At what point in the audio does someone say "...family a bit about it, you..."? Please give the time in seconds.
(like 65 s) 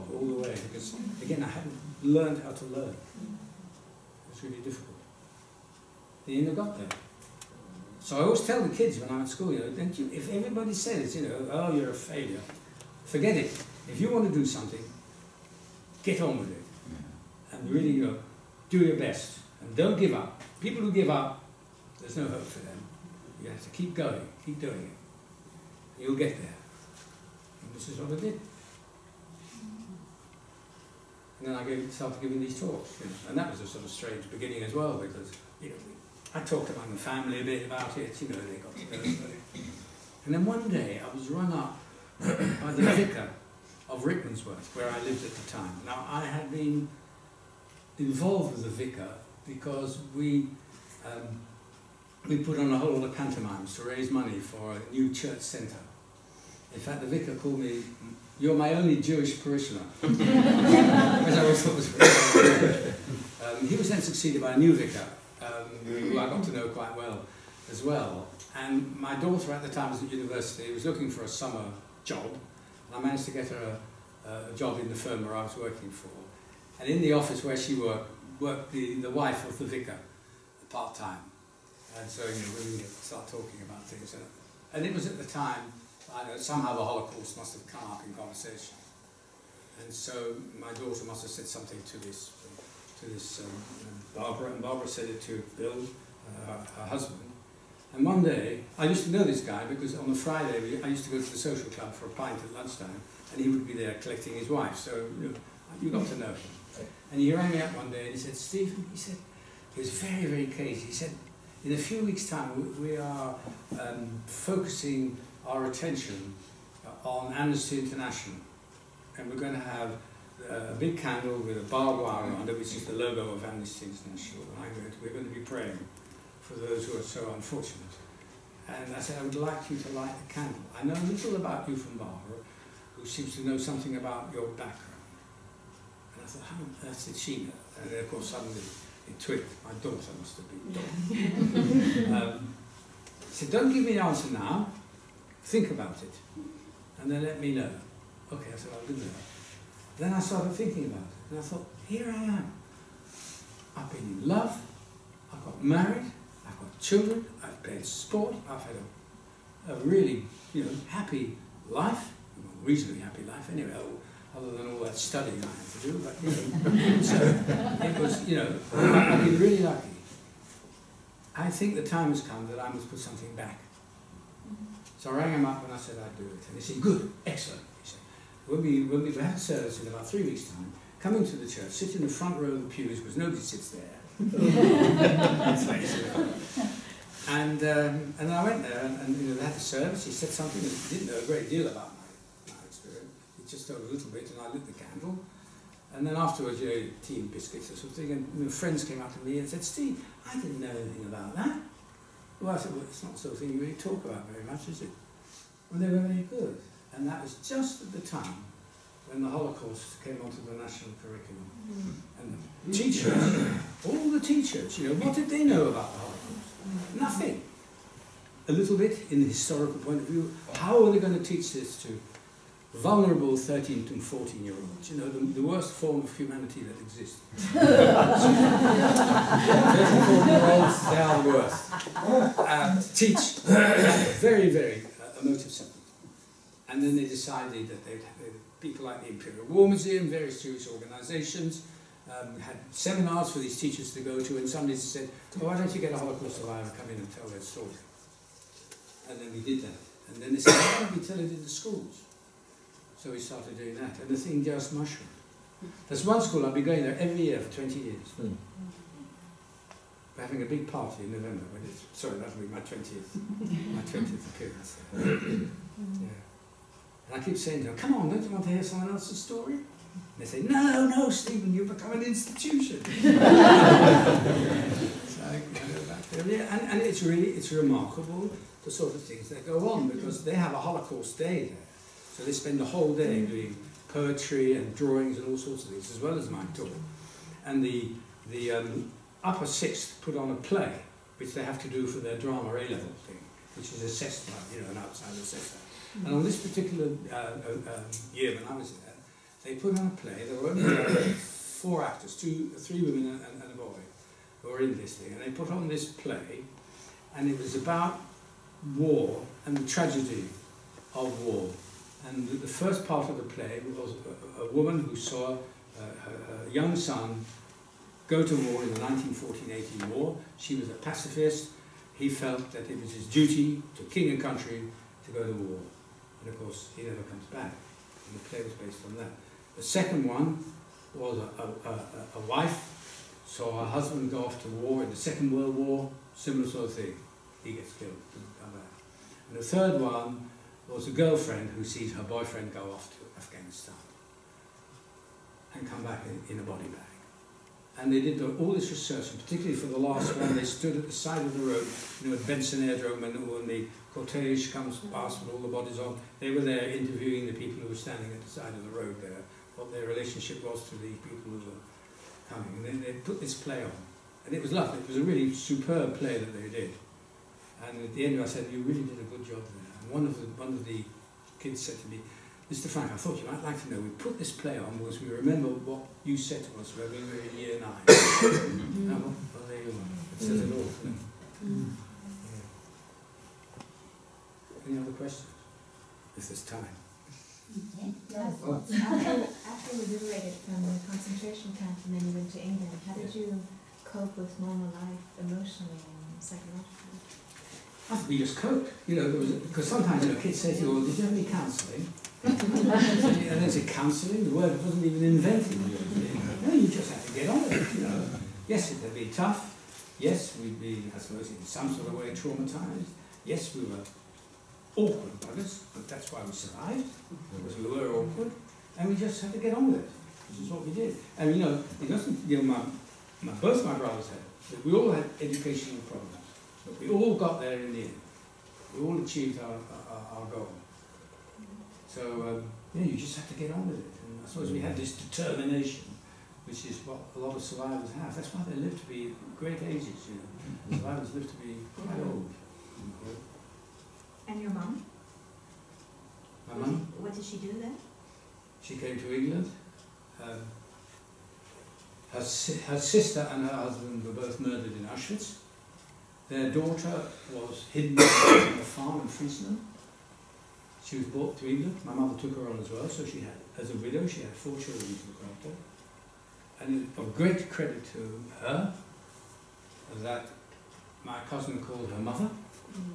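36 s.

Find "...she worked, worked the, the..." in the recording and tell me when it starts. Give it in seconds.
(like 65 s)
77 s.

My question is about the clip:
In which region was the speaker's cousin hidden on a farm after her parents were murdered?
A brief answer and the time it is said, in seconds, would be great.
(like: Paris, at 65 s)
Friesland, at 459 s.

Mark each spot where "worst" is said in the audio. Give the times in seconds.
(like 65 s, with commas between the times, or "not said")
225 s, 231 s.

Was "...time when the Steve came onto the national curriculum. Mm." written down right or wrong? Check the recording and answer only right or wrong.
wrong.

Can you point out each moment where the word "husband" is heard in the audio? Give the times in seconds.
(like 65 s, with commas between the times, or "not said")
96 s, 333 s, 453 s.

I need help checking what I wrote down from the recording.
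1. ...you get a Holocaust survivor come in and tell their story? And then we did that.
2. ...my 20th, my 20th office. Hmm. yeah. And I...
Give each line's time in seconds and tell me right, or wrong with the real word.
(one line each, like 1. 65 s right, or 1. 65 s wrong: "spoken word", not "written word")
1. 245 s right
2. 262 s wrong: "appearance", not "office".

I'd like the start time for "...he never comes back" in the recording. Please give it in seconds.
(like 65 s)
326 s.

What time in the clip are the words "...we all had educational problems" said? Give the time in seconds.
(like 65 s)
424 s.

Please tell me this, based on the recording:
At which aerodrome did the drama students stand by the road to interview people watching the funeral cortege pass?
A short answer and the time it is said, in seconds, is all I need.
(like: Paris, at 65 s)
Benson Aerodrome, at 352 s.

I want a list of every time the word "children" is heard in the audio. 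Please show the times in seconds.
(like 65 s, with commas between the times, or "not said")
156 s, 464 s.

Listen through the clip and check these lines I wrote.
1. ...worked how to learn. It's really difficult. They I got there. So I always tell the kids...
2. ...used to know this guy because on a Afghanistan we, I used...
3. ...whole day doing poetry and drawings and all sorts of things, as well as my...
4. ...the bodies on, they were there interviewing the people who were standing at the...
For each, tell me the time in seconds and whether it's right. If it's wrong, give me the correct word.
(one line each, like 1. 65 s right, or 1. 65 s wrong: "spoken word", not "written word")
1. 2 s wrong: "learned", not "worked"
2. 98 s wrong: "Friday", not "Afghanistan"
3. 282 s right
4. 355 s right.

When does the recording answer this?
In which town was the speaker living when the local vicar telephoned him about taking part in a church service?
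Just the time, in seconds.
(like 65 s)
44 s.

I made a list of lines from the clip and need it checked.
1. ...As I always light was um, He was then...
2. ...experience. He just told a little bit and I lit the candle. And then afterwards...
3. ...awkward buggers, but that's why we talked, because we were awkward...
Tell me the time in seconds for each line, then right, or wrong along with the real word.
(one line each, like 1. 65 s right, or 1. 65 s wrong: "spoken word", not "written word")
1. 60 s wrong: "thought", not "light"
2. 192 s right
3. 414 s wrong: "survived", not "talked".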